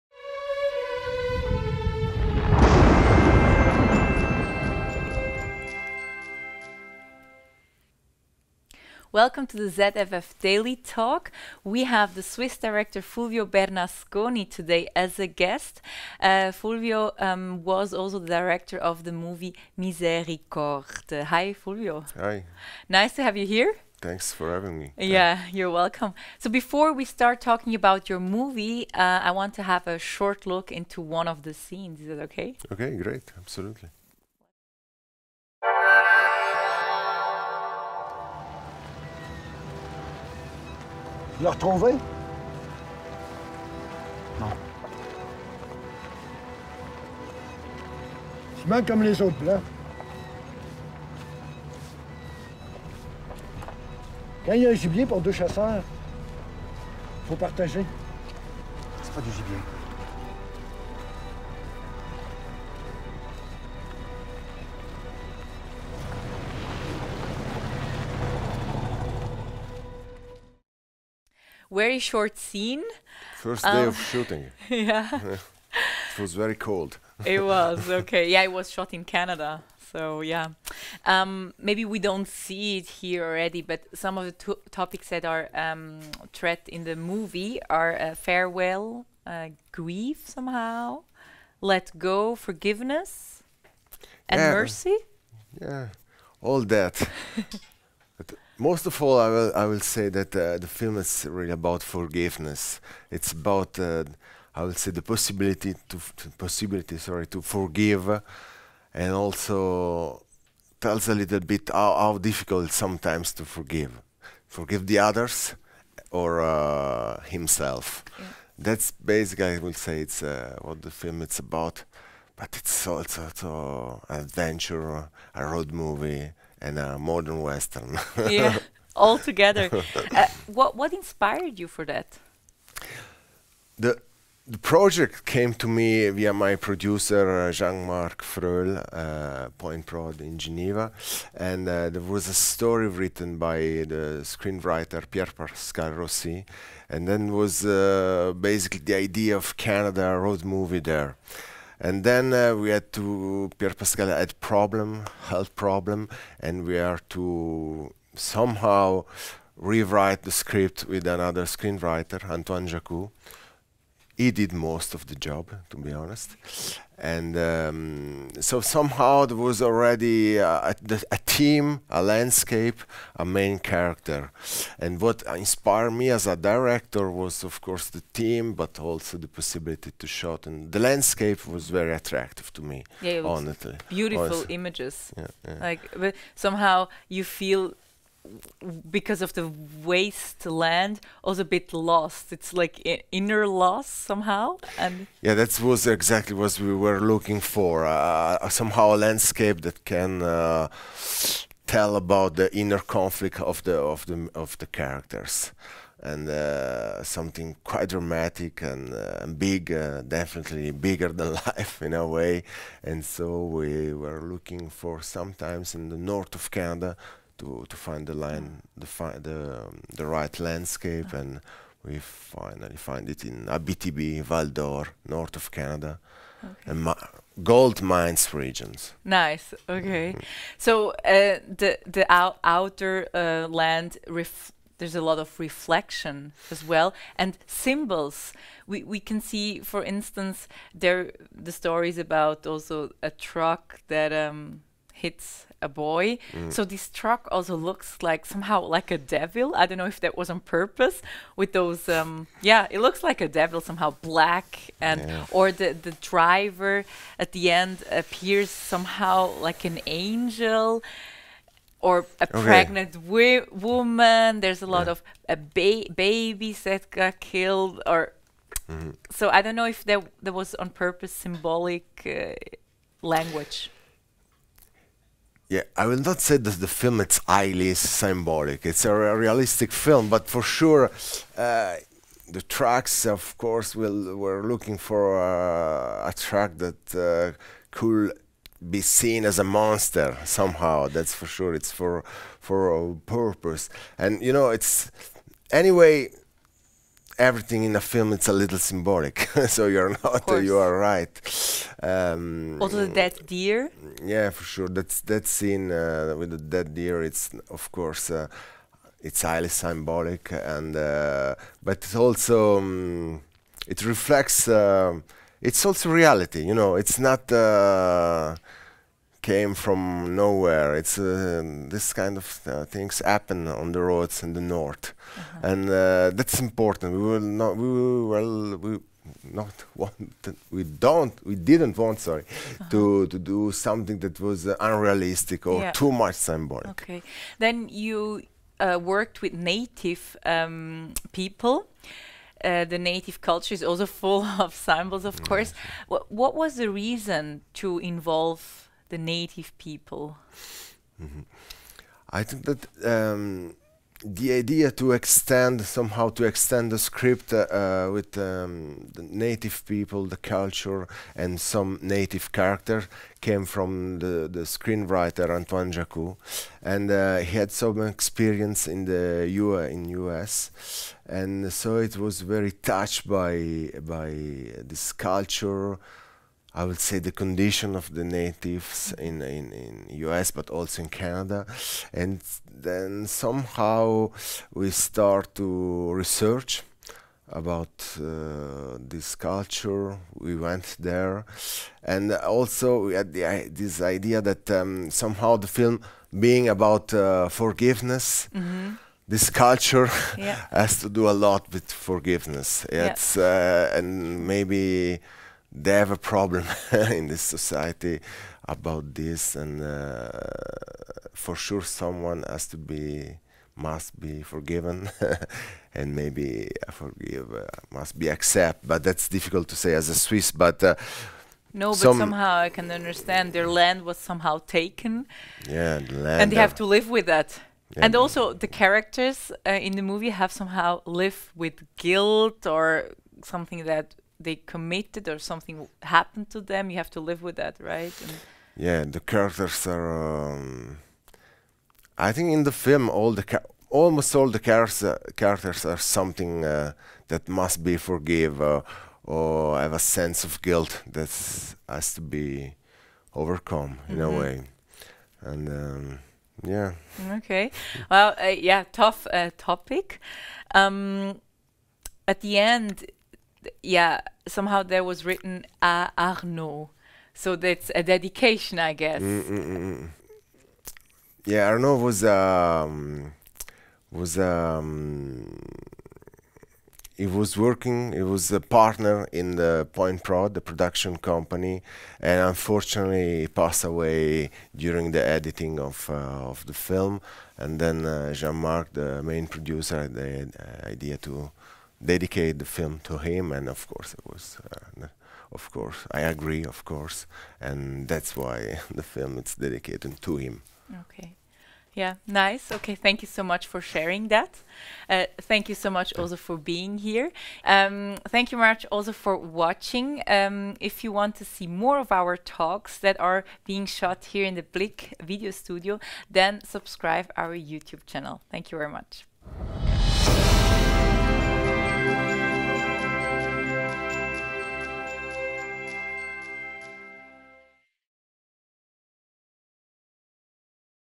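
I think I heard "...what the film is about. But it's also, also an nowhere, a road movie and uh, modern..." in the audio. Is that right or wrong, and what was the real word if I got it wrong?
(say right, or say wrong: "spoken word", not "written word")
wrong: "adventure", not "nowhere".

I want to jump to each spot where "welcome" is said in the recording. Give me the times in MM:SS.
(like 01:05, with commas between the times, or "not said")
00:09, 00:25.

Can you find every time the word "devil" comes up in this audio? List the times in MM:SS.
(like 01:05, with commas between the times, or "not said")
04:08, 04:13.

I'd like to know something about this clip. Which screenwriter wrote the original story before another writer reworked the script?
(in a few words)
Pierre Pascal Rossi.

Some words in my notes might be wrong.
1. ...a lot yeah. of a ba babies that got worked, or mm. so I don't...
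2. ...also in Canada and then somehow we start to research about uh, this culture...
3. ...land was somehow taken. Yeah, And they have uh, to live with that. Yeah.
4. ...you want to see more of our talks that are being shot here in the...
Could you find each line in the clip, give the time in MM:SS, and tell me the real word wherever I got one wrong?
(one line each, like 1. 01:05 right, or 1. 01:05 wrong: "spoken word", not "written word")
1. 04:24 wrong: "killed", not "worked"
2. 06:20 right
3. 07:03 right
4. 08:30 right.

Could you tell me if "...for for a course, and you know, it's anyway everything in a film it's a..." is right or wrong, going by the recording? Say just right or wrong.
wrong.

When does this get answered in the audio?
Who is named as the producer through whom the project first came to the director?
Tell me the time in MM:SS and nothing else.
02:17.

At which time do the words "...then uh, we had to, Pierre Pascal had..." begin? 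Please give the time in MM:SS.
02:32.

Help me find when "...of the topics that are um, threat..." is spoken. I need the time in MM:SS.
01:24.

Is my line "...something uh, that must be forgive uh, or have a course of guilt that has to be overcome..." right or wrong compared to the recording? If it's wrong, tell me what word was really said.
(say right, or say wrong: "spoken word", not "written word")
wrong: "sense", not "course".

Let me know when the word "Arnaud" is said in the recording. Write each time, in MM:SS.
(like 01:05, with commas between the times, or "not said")
07:45, 07:51.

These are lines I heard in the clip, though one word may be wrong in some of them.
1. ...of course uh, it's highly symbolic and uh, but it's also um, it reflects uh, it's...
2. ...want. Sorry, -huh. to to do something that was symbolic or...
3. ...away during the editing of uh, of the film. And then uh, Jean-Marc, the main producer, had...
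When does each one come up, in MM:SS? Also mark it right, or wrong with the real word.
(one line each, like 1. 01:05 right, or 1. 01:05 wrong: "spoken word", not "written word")
1. 05:07 right
2. 05:31 wrong: "unrealistic", not "symbolic"
3. 08:03 right.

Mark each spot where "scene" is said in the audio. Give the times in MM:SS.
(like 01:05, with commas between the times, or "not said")
00:31, 01:12, 05:05.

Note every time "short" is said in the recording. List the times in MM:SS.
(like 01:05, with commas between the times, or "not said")
00:29, 01:11.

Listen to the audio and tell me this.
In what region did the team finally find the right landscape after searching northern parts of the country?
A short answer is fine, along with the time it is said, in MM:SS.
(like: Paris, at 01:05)
Abitibi, at 03:43.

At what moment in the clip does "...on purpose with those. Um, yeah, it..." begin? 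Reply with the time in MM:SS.
04:10.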